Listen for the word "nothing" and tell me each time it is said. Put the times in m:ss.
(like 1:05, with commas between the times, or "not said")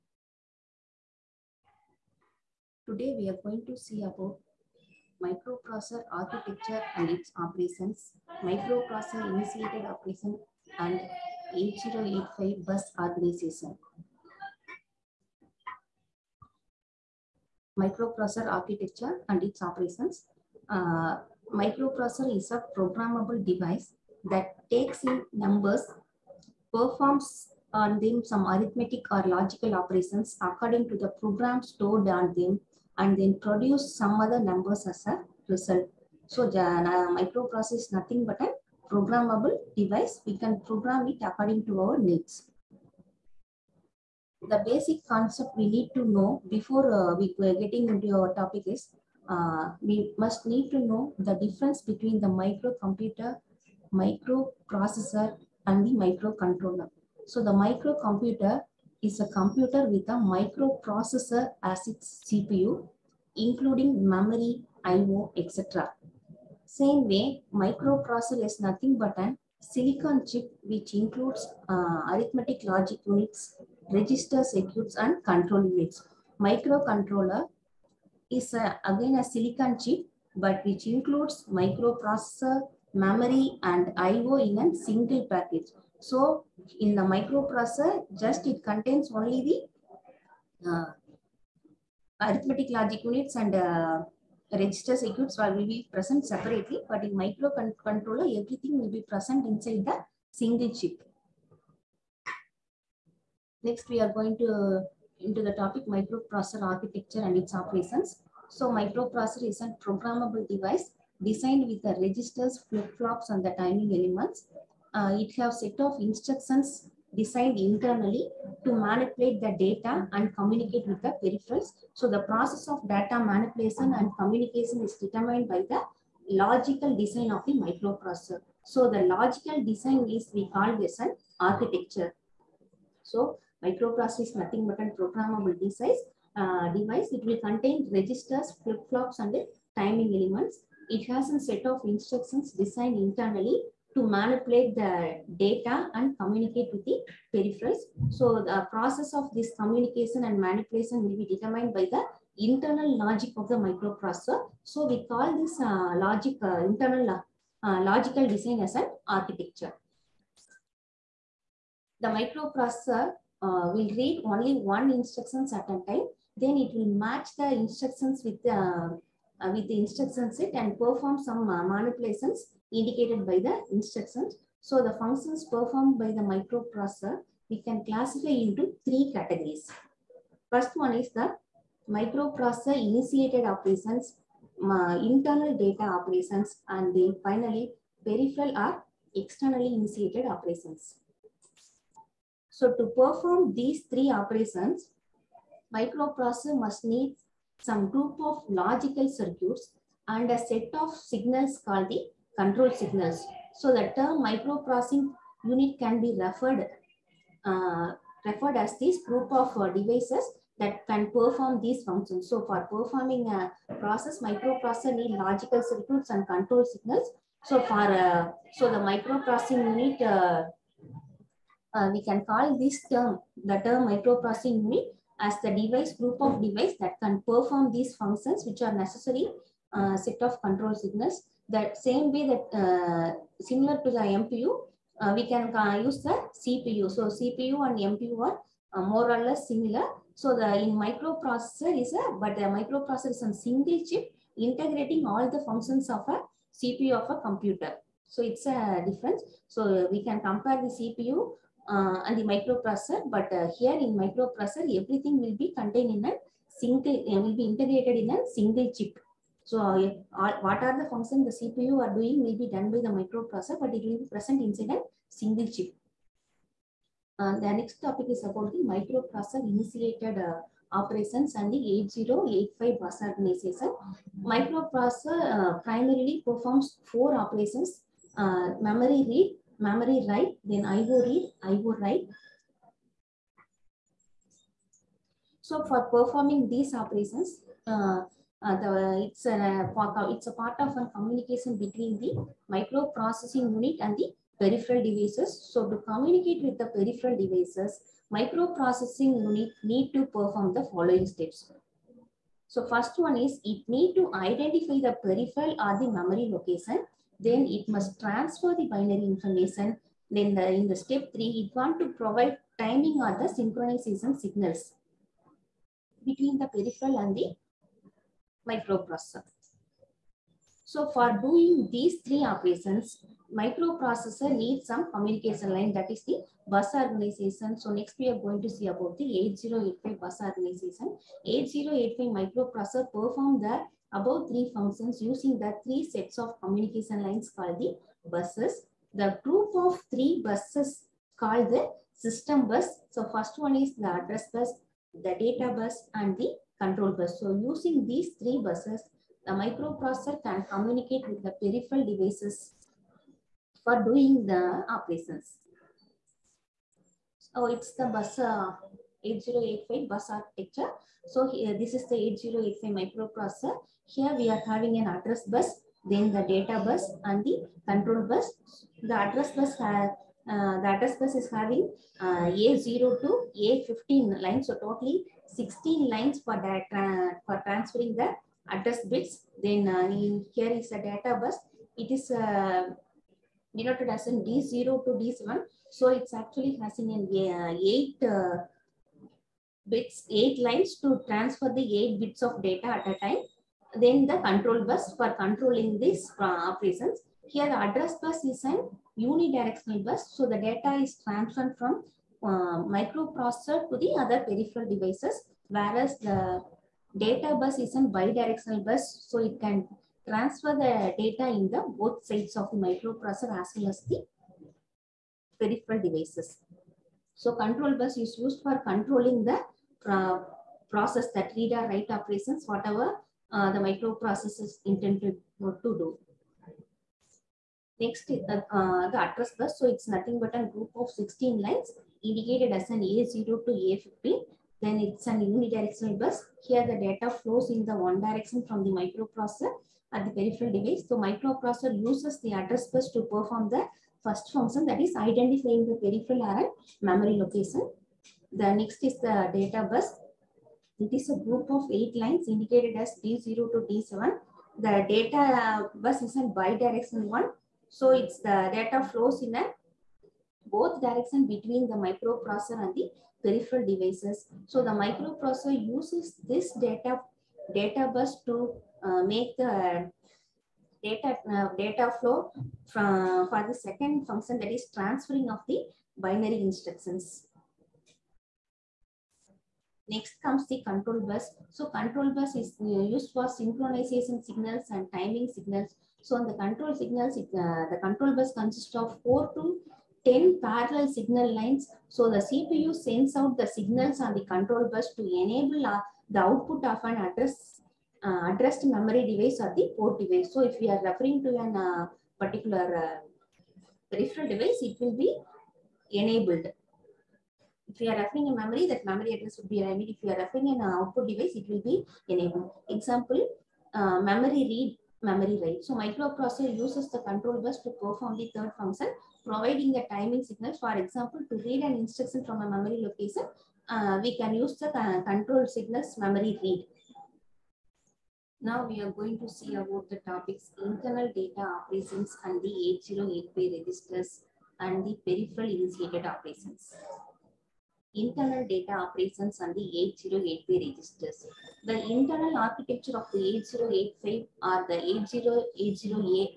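0:37, 1:08, 2:14, 7:09.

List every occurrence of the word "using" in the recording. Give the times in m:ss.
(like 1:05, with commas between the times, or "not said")
5:35, 5:47.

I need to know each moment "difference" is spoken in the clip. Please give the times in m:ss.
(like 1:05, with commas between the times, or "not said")
0:51, 4:08.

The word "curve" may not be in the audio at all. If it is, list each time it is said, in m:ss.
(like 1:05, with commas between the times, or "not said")
not said.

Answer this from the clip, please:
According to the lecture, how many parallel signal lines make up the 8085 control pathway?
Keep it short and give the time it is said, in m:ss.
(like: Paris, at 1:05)
4 to 10, at 8:09.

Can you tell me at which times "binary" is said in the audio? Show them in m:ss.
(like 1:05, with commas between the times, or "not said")
5:08, 7:55.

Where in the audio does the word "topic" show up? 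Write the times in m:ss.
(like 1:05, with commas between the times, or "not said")
0:48, 1:45, 4:27, 8:49.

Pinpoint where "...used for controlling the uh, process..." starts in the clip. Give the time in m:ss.
6:58.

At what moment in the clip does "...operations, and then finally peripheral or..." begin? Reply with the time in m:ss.
3:05.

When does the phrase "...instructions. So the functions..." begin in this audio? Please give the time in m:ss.
2:53.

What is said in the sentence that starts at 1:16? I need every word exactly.
Microcontroller is a, again a silicon chip but which includes microprocessor, memory and I.O.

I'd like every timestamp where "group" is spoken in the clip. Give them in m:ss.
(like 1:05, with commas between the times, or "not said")
3:17, 3:29, 3:45, 5:39, 7:10, 7:31.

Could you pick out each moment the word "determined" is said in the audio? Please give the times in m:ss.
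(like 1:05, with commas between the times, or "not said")
2:04, 2:31.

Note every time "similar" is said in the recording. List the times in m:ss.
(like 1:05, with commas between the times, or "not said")
3:53, 3:59.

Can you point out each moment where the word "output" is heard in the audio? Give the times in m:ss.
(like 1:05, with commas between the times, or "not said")
8:16, 8:30.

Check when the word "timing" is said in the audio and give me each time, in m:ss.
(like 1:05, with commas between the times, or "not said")
1:53, 2:19, 5:12, 8:04, 8:39.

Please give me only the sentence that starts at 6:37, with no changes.
Here the address bus is an unidirectional bus.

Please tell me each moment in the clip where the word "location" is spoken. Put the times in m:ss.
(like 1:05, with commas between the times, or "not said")
5:06, 7:27, 8:42.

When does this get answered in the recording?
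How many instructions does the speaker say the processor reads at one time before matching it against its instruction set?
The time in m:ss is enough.
2:44.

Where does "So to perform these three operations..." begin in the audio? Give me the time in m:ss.
3:12.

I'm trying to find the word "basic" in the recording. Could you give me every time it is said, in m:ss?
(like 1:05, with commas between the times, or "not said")
0:44.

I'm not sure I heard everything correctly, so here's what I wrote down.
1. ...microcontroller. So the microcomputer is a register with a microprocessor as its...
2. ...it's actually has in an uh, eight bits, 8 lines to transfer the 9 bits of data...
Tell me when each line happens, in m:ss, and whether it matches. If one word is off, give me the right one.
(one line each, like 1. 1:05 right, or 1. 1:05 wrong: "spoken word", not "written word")
1. 0:56 wrong: "computer", not "register"
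2. 6:25 wrong: "8", not "9".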